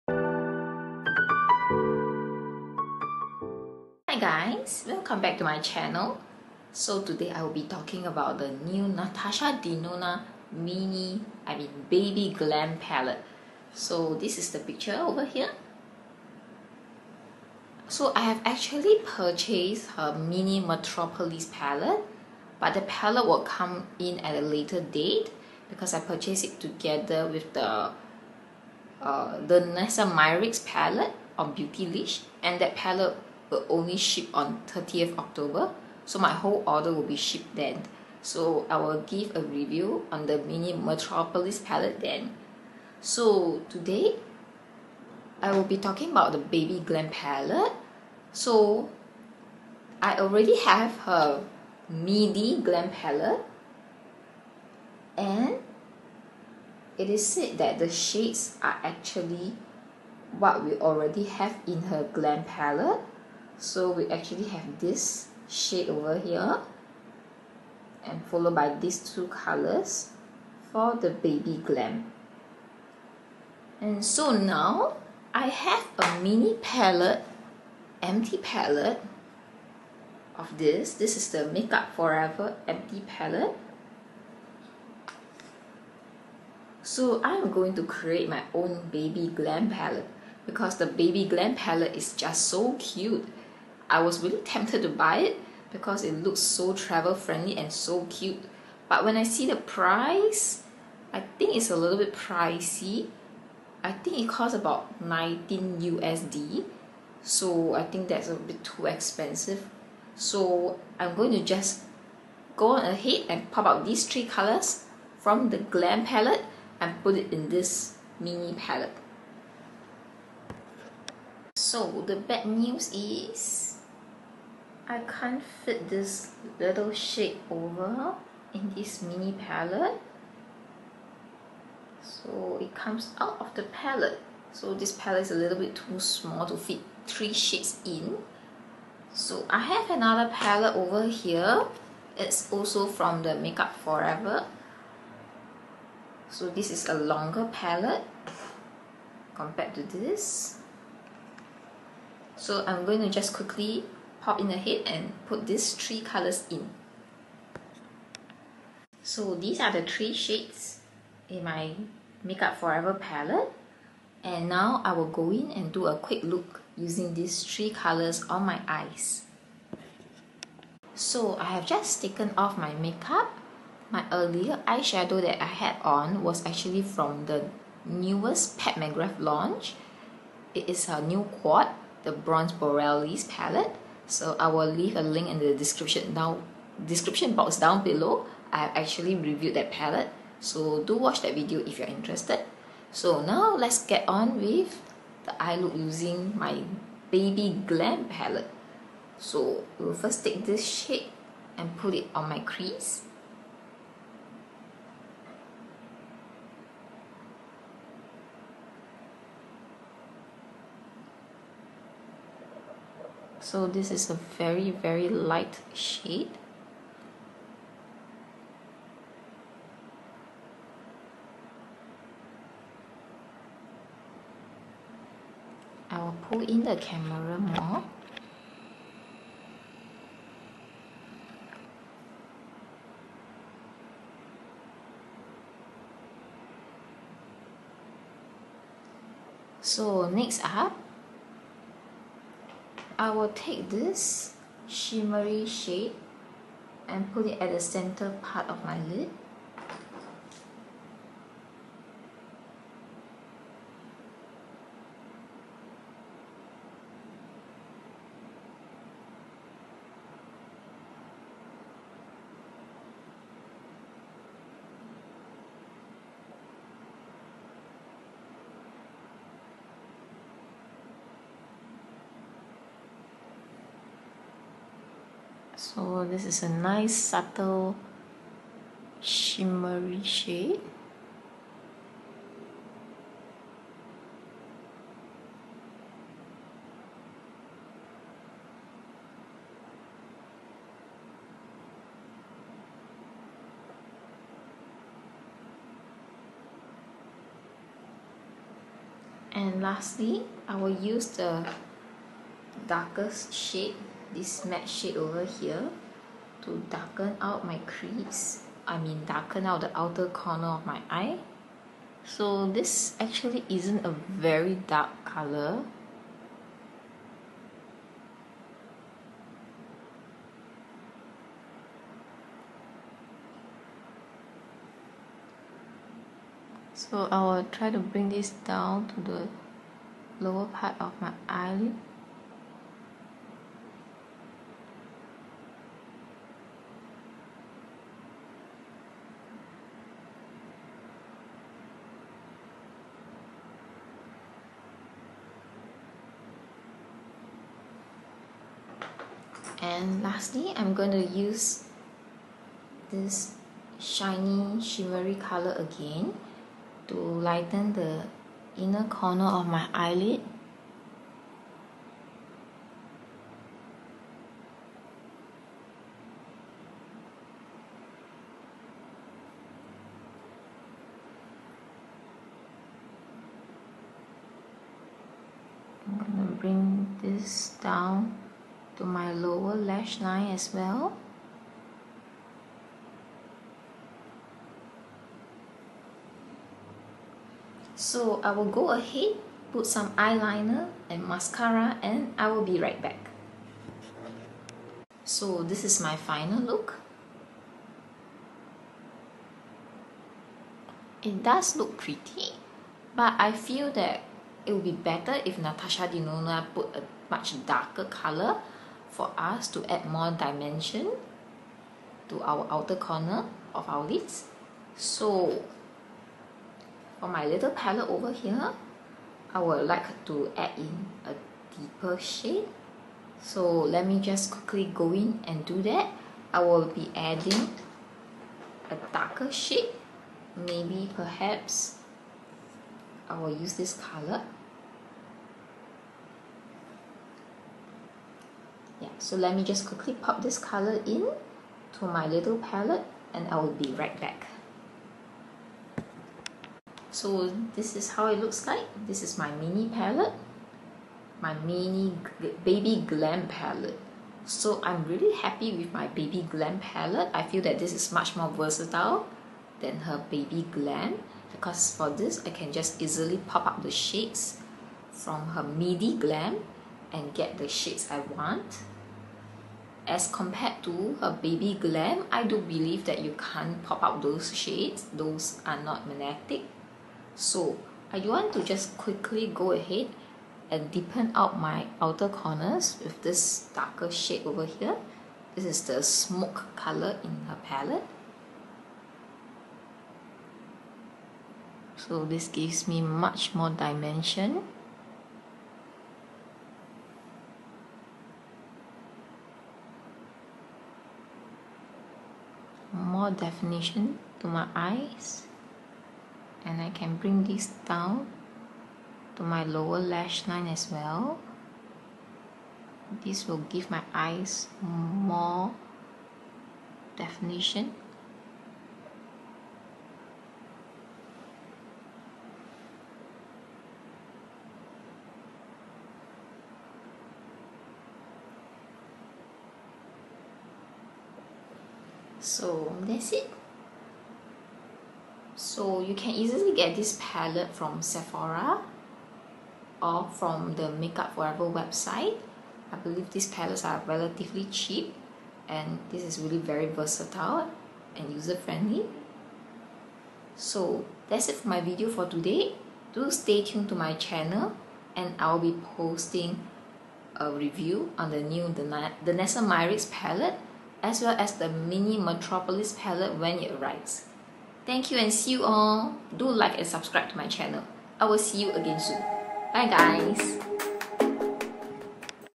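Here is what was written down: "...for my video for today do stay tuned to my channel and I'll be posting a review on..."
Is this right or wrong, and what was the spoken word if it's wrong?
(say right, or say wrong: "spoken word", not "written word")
right.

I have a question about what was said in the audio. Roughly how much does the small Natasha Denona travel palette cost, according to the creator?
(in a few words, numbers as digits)
19 USD.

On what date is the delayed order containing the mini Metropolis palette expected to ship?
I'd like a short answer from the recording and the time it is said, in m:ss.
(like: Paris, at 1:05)
30th October, at 0:34.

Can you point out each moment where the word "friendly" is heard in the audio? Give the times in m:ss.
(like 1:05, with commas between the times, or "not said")
1:37, 9:08.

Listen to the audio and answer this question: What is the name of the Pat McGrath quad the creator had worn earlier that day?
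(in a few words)
Bronze Borealis.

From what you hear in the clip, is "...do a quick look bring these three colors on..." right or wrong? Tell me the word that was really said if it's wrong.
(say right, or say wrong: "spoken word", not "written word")
wrong: "using", not "bring".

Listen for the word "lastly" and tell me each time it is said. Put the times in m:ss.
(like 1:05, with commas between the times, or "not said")
4:59, 5:50.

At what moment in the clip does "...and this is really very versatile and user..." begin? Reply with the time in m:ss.
9:05.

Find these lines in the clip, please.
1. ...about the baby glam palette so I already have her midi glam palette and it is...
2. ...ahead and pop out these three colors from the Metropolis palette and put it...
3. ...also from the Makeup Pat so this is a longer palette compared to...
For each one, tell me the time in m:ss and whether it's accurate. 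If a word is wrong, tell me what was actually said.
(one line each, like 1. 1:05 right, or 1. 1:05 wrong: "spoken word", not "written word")
1. 0:46 right
2. 1:52 wrong: "Glam", not "Metropolis"
3. 2:22 wrong: "Forever", not "Pat".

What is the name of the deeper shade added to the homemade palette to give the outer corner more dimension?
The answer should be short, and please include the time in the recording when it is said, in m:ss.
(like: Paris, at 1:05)
smoke, at 8:05.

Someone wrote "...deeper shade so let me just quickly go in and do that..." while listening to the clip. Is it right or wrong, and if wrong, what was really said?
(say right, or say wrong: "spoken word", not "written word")
right.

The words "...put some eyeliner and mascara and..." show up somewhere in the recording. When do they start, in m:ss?
6:29.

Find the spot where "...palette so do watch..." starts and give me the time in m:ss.
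3:09.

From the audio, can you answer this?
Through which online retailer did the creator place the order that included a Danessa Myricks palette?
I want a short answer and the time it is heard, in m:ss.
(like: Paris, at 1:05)
Beautylish, at 0:31.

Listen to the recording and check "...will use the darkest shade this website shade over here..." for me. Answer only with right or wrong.
wrong.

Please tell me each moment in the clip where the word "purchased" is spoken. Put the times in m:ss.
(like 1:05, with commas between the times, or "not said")
0:19, 0:25.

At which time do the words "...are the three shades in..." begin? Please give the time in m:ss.
2:39.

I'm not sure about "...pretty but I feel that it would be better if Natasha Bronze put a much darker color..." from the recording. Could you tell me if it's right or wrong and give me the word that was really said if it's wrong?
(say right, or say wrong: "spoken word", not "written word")
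wrong: "Denona", not "Bronze".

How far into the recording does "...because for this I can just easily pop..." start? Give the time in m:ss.
7:41.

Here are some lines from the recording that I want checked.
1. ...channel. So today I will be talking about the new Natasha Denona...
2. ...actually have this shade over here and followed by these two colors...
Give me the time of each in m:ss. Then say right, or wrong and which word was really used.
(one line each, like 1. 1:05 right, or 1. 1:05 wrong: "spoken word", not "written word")
1. 0:05 right
2. 1:04 right.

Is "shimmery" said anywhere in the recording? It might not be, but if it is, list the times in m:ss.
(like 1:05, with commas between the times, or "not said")
4:04, 4:38, 5:54.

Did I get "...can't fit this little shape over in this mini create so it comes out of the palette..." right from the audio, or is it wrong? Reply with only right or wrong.
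wrong.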